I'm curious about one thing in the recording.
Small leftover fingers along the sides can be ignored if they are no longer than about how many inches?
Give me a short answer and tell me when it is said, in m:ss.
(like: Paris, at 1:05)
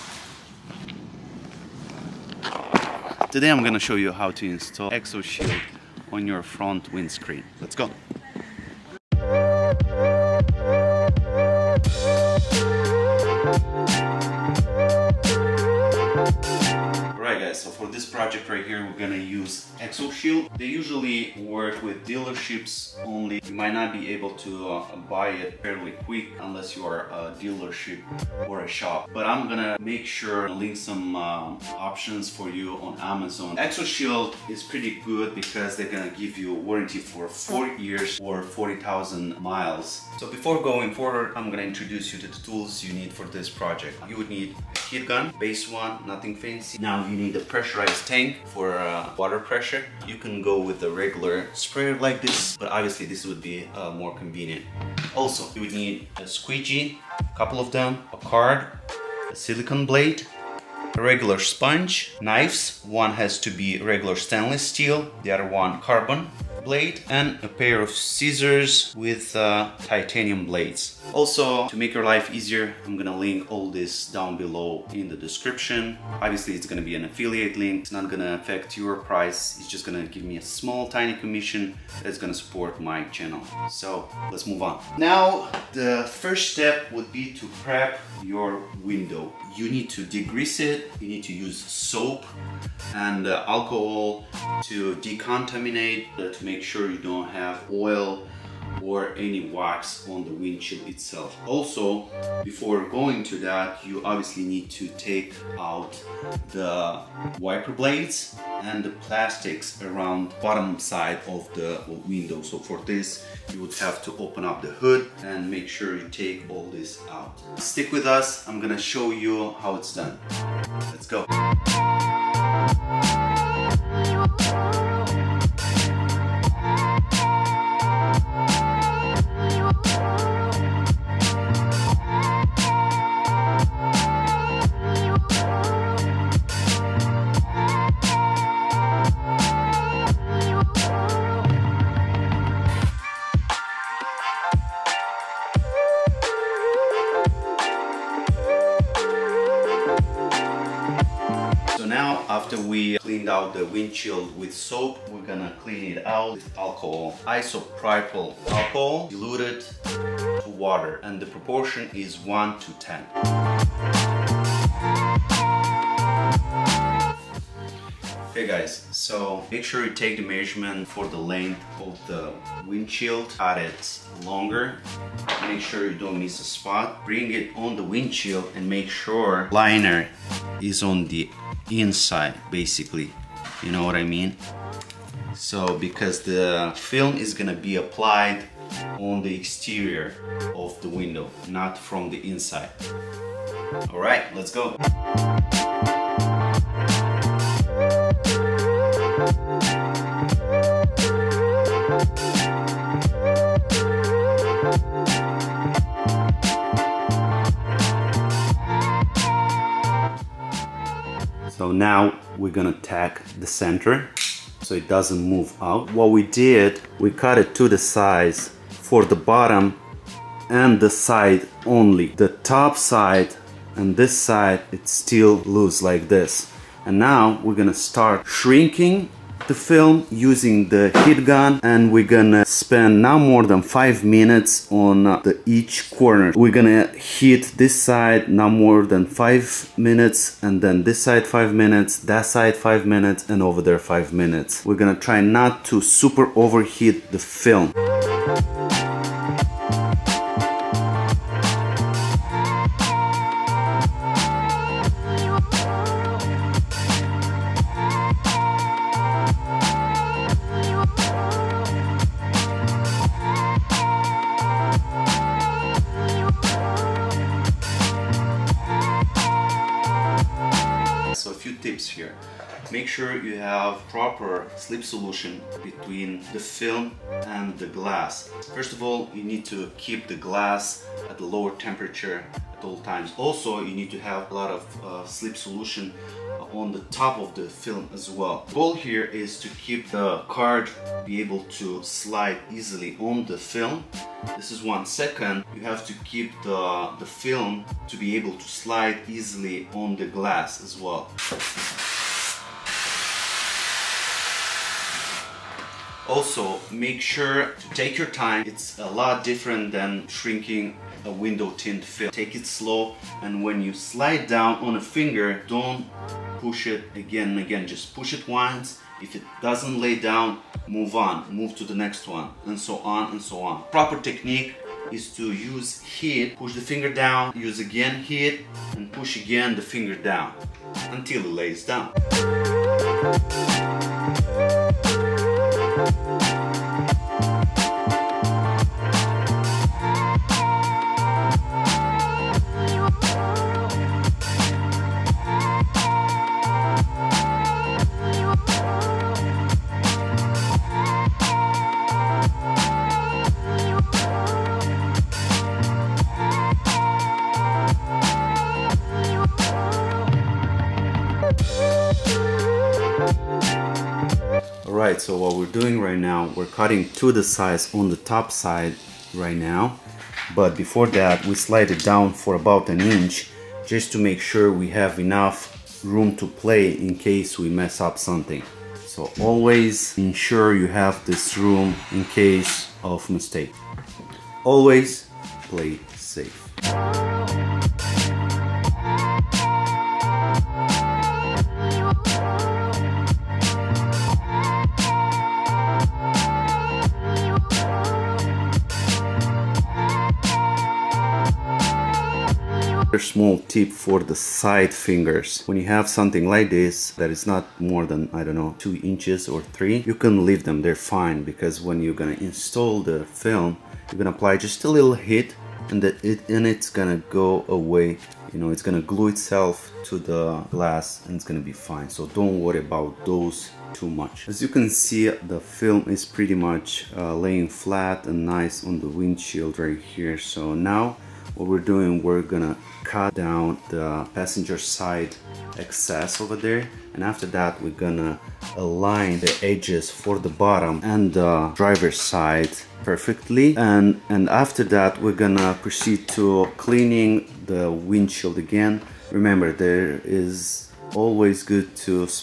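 2 or 3 inches, at 6:48.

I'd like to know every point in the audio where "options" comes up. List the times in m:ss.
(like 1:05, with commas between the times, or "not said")
0:31.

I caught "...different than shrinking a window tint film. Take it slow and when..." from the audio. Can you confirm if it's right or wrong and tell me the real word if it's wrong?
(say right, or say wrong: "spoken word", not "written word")
right.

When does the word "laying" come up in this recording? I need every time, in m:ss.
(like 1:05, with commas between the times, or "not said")
7:07.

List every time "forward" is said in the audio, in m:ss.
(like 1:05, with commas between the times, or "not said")
0:40.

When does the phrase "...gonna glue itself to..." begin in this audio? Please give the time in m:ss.
6:58.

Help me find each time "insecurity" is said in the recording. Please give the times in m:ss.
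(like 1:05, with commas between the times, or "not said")
not said.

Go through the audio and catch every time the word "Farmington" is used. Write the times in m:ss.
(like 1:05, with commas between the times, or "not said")
not said.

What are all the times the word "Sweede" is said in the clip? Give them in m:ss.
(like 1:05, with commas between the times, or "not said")
not said.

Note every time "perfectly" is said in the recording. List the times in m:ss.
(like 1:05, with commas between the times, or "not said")
7:22.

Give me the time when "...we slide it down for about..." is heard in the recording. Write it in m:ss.
6:11.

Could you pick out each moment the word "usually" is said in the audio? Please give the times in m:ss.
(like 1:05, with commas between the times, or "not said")
0:20.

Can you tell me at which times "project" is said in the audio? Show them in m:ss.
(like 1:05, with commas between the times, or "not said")
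0:18, 0:43.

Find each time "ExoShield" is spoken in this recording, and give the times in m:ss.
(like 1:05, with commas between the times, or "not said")
0:04, 0:19, 0:33.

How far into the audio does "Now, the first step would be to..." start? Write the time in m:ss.
1:24.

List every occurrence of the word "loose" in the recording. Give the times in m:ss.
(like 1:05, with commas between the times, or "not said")
3:45.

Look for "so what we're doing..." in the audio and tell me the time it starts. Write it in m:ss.
6:05.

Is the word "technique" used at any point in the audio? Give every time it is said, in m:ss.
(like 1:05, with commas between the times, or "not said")
5:24.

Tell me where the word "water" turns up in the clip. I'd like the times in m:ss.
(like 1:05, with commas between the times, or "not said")
0:49, 2:40.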